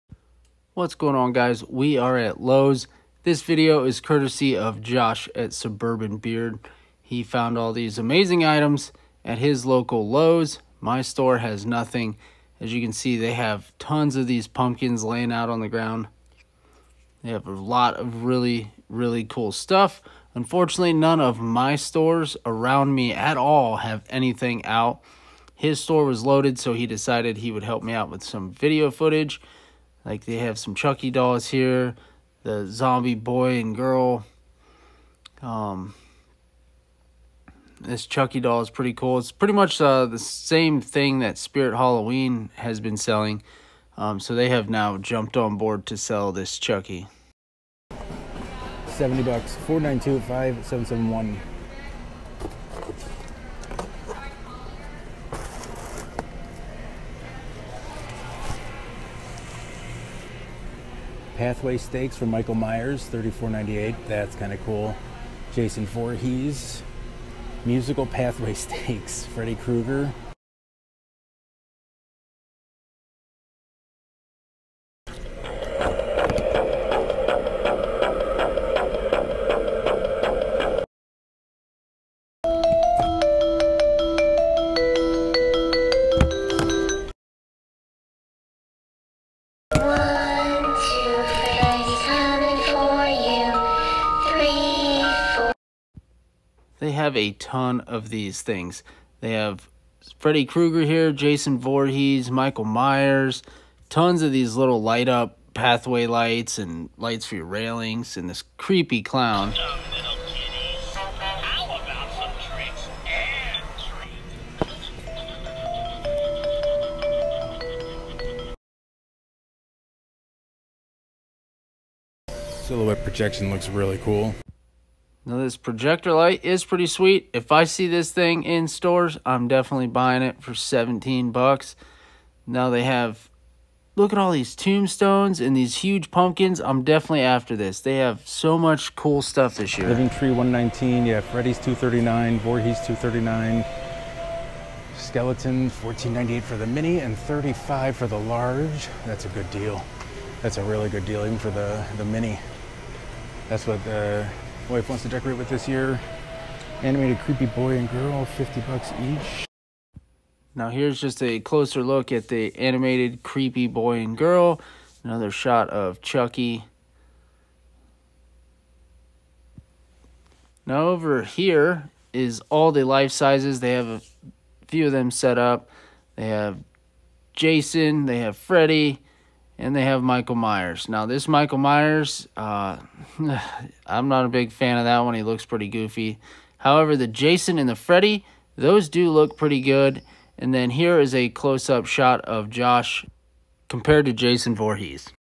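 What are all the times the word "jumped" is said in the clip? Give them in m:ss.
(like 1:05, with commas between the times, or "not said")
0:44.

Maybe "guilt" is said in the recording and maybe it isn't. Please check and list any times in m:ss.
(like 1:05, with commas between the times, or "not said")
not said.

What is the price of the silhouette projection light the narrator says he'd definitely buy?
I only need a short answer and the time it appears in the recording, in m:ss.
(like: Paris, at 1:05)
$17, at 2:10.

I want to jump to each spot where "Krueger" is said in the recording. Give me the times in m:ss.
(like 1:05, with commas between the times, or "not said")
1:09, 1:40.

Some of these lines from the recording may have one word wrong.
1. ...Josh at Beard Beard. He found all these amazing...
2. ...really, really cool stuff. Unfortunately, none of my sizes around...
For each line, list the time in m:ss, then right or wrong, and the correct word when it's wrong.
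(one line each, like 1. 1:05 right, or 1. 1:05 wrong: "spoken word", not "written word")
1. 0:04 wrong: "Suburban", not "Beard"
2. 0:18 wrong: "stores", not "sizes".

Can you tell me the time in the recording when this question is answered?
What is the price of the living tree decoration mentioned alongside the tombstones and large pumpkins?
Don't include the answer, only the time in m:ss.
2:20.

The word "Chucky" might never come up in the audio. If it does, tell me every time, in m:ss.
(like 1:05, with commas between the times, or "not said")
0:30, 0:38, 0:46, 2:46.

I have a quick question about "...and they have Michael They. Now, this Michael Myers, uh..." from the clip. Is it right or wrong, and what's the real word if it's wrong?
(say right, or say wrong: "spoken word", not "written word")
wrong: "Myers", not "They".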